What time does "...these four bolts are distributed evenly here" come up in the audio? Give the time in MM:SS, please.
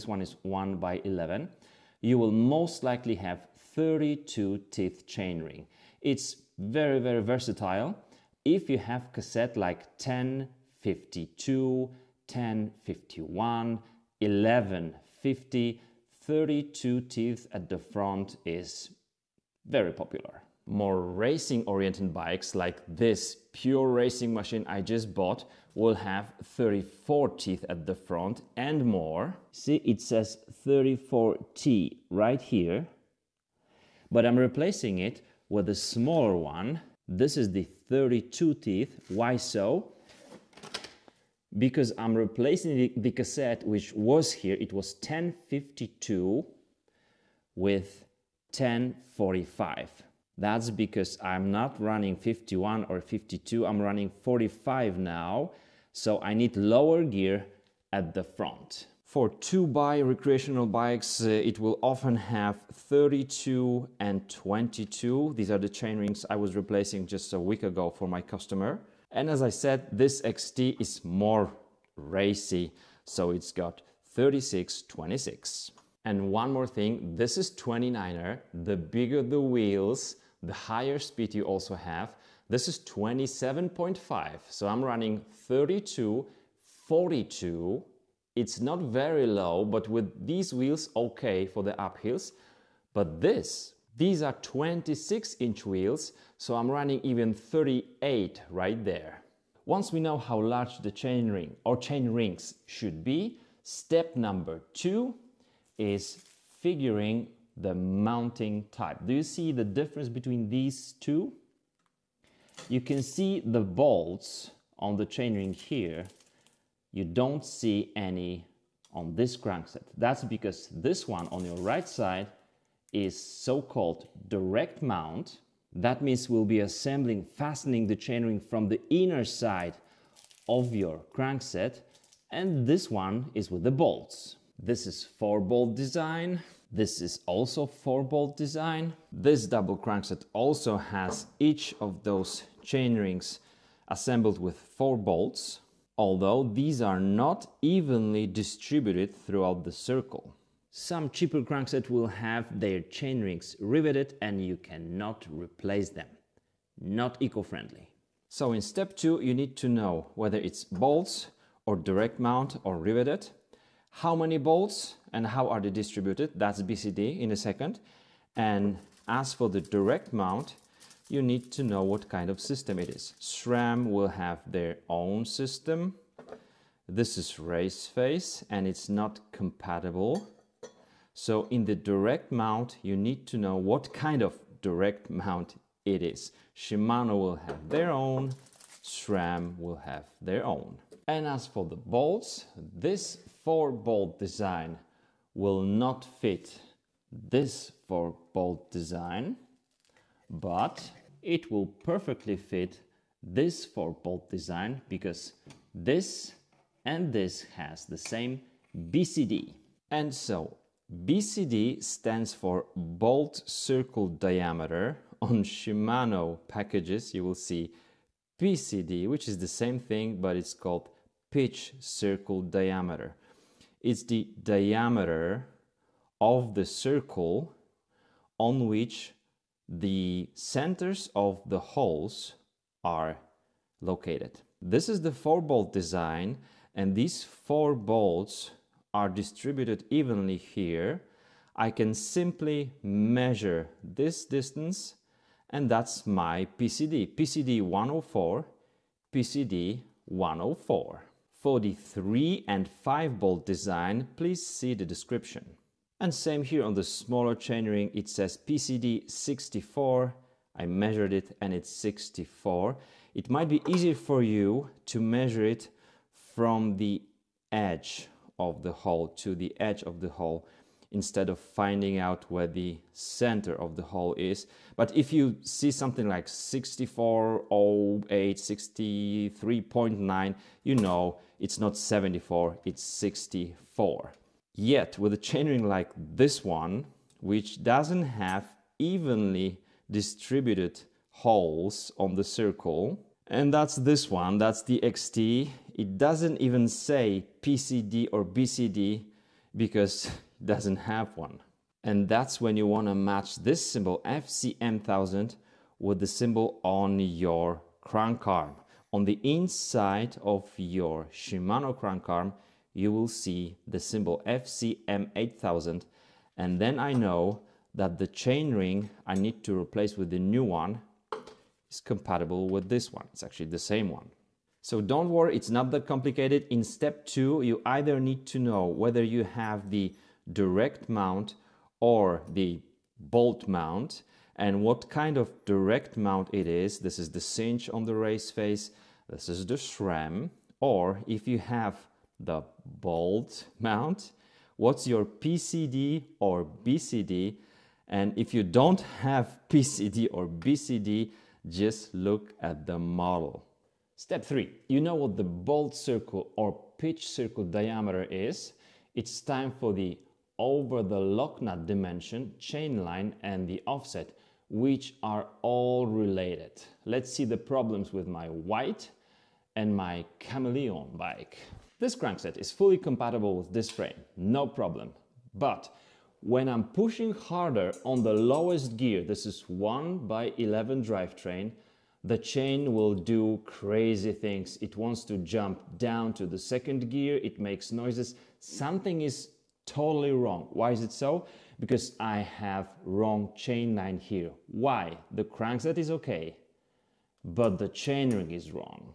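03:56.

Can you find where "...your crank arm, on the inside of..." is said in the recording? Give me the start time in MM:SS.
05:06.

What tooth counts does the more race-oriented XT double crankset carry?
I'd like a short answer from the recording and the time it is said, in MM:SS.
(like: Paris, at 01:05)
36, 26, at 01:14.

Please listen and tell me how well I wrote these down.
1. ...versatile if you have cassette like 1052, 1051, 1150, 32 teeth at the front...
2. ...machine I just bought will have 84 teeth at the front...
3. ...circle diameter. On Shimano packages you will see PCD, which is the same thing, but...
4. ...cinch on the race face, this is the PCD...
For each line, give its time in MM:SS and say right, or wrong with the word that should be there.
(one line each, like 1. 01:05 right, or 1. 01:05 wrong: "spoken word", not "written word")
1. 00:07 right
2. 00:24 wrong: "34", not "84"
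3. 03:33 right
4. 05:37 wrong: "SRAM", not "PCD".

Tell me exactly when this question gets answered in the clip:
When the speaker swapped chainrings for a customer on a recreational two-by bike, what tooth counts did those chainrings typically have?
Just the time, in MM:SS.
01:02.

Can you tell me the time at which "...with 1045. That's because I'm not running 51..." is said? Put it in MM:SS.
00:47.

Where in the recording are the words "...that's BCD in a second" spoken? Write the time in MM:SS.
02:46.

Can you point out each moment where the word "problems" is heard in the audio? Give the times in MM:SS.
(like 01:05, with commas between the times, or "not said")
06:07, 06:14.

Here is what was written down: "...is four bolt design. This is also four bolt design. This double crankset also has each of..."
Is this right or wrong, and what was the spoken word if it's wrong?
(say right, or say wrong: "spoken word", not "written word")
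right.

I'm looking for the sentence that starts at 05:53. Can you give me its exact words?
Step three, you know what the bolt circle or pitch circle diameter is.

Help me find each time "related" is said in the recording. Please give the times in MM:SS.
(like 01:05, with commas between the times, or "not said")
06:05.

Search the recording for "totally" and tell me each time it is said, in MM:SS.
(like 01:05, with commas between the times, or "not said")
06:29.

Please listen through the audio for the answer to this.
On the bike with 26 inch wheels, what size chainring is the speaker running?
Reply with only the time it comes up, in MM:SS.
01:37.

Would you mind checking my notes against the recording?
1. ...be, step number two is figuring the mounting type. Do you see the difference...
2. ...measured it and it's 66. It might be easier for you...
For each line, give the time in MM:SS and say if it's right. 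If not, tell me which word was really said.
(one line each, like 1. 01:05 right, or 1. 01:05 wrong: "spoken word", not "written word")
1. 01:43 right
2. 04:20 wrong: "64", not "66".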